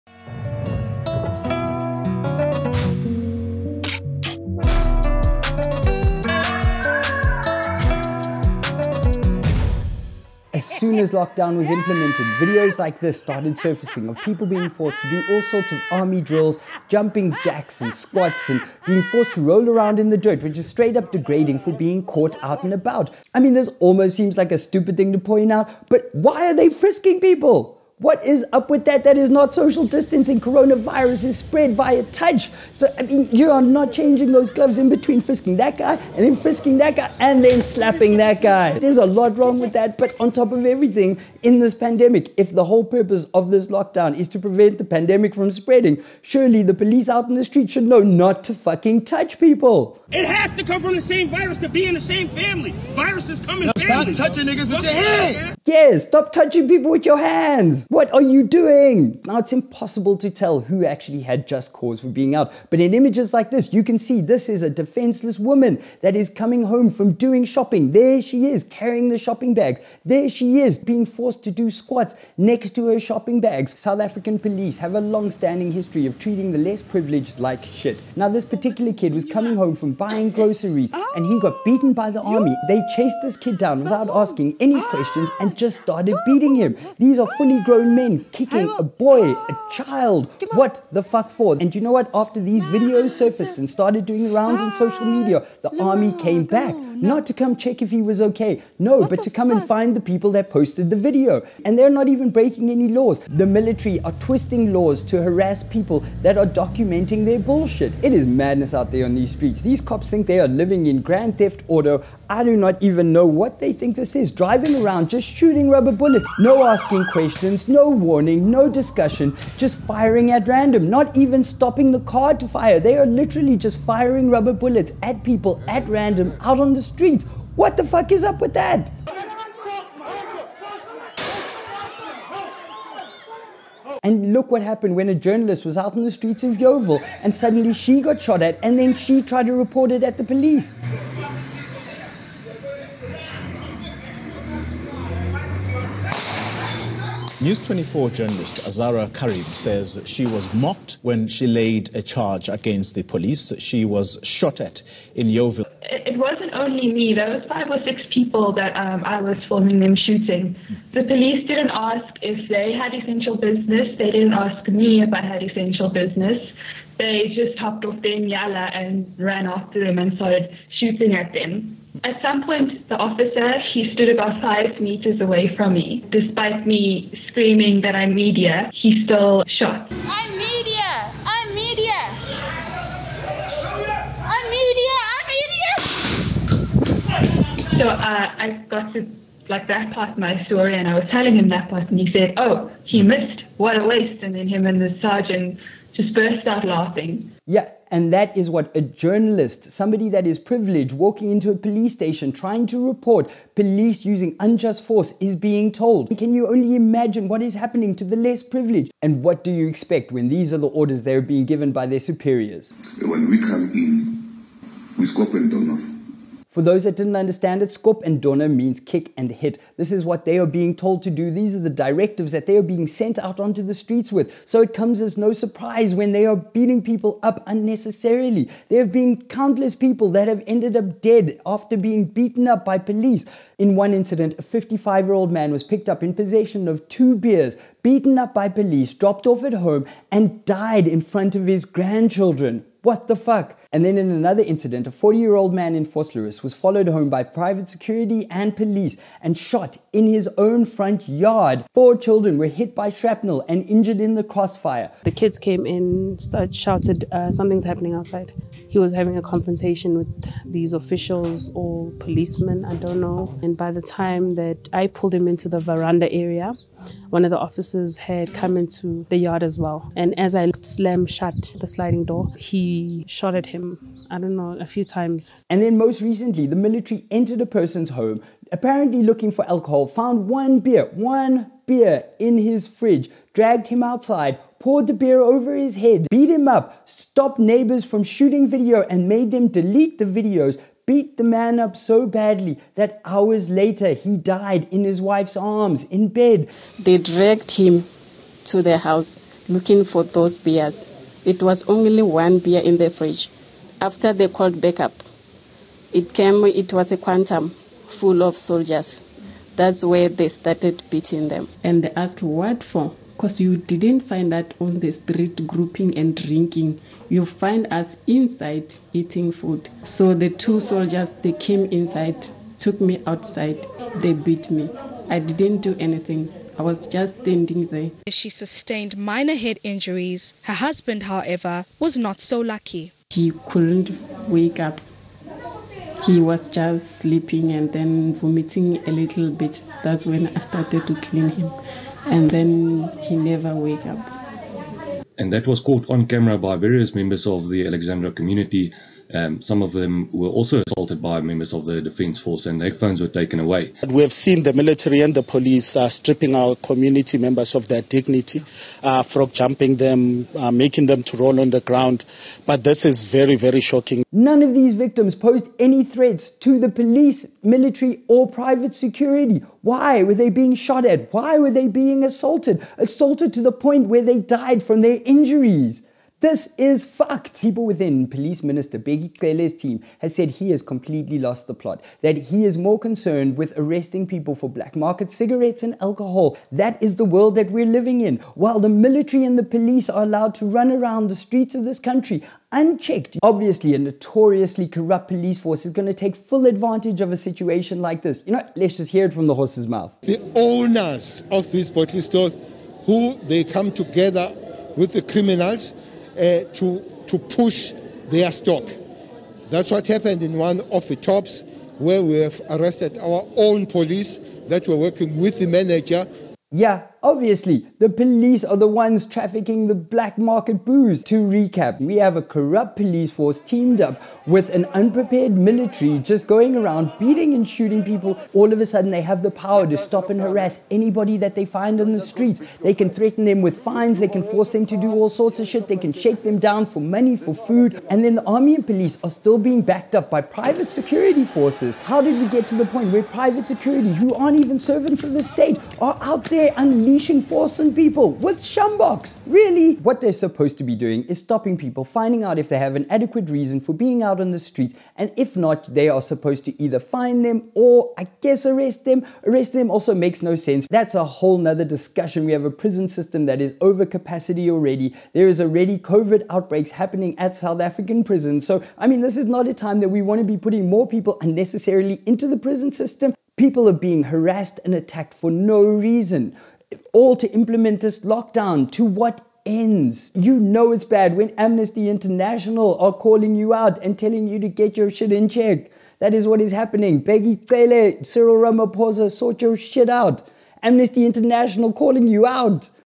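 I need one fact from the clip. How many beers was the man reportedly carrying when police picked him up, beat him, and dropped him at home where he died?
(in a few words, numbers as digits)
2.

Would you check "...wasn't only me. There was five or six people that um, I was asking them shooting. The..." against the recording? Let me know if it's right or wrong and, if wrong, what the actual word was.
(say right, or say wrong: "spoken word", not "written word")
wrong: "filming", not "asking".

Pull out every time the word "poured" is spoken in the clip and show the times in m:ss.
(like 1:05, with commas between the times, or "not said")
4:44.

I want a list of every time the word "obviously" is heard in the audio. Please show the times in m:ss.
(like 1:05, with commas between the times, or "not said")
6:33, 6:57.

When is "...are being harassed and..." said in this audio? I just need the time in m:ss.
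7:53.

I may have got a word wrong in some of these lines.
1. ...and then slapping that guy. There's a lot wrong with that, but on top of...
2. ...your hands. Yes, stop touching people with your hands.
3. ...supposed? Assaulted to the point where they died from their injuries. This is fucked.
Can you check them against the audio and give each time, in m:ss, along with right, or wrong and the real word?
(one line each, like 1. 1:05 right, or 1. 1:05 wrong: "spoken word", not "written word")
1. 0:37 right
2. 0:54 right
3. 6:12 wrong: "assaulted", not "supposed".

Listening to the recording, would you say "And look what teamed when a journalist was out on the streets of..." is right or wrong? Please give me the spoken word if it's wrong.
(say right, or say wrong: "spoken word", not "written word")
wrong: "happened", not "teamed".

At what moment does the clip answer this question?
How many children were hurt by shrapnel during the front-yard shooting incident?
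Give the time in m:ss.
4:11.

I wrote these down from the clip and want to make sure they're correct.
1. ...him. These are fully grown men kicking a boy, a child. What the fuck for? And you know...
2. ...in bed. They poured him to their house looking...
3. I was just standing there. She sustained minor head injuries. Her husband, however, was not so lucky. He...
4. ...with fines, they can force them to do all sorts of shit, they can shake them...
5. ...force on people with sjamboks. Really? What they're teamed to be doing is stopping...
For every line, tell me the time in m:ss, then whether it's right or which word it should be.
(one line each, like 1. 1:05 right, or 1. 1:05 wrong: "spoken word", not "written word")
1. 1:26 right
2. 4:55 wrong: "dragged", not "poured"
3. 5:26 right
4. 7:13 right
5. 7:27 wrong: "supposed", not "teamed".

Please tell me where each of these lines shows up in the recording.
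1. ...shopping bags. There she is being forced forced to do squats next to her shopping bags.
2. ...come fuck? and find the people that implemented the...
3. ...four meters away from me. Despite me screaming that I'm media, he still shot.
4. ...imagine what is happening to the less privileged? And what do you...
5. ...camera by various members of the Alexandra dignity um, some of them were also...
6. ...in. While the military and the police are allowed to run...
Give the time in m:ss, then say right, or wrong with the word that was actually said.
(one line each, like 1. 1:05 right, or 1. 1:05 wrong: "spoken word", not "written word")
1. 1:09 right
2. 1:39 wrong: "posted", not "implemented"
3. 2:54 wrong: "five", not "four"
4. 3:26 right
5. 5:46 wrong: "community", not "dignity"
6. 6:28 right.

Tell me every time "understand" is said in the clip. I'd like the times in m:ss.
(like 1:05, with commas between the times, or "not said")
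3:37.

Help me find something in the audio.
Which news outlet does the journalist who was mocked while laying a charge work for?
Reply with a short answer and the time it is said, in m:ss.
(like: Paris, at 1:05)
News 24, at 2:27.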